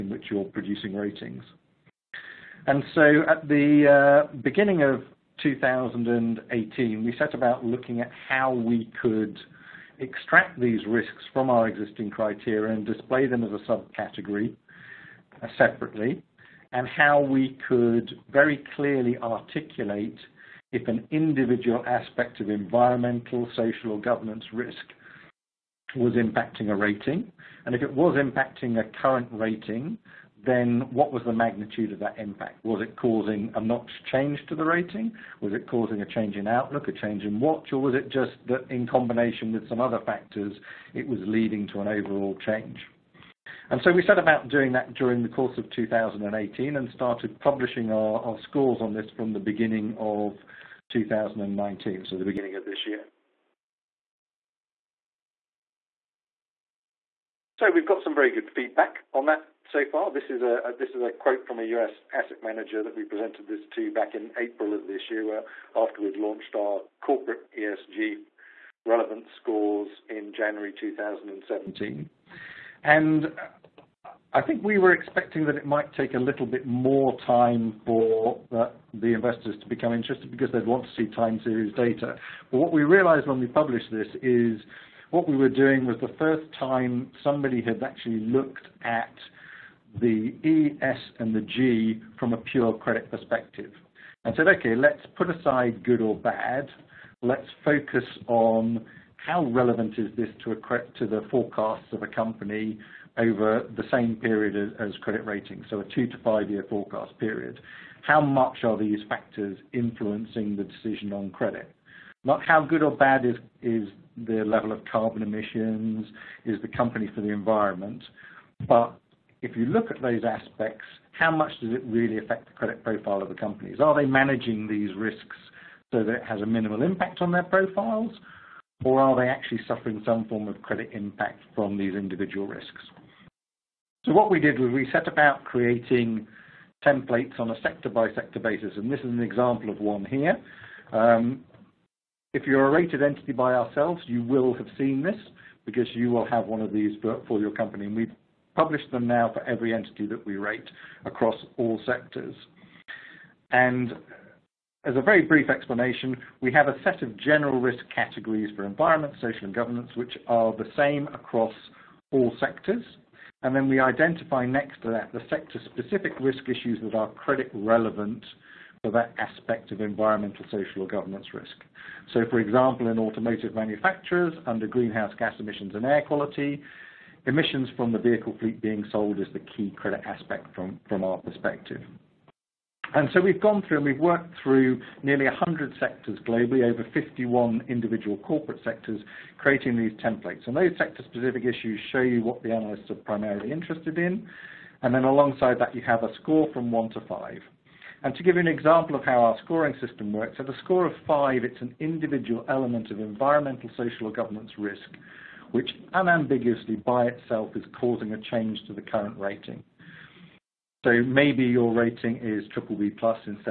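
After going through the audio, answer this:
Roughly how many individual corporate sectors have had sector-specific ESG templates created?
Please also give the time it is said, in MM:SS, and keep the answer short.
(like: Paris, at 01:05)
51, at 03:06.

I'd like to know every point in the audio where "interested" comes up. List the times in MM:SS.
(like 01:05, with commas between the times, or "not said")
01:19, 03:13.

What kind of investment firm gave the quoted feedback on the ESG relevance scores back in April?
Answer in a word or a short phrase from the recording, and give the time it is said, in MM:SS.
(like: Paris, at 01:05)
US asset manager, at 01:01.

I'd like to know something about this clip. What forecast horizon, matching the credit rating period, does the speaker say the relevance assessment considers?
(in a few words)
2 to 5 years.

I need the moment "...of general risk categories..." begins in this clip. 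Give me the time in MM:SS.
02:37.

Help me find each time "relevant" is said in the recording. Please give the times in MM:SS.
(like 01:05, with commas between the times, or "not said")
01:08, 01:39, 02:47.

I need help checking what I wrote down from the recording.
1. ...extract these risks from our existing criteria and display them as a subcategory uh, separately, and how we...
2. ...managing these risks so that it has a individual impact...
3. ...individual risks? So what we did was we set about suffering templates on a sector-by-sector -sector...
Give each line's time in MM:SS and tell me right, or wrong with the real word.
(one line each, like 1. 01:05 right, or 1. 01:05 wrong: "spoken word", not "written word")
1. 00:10 right
2. 02:04 wrong: "minimal", not "individual"
3. 02:11 wrong: "creating", not "suffering".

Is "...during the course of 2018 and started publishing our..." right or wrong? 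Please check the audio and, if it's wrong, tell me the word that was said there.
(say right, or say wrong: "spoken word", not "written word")
right.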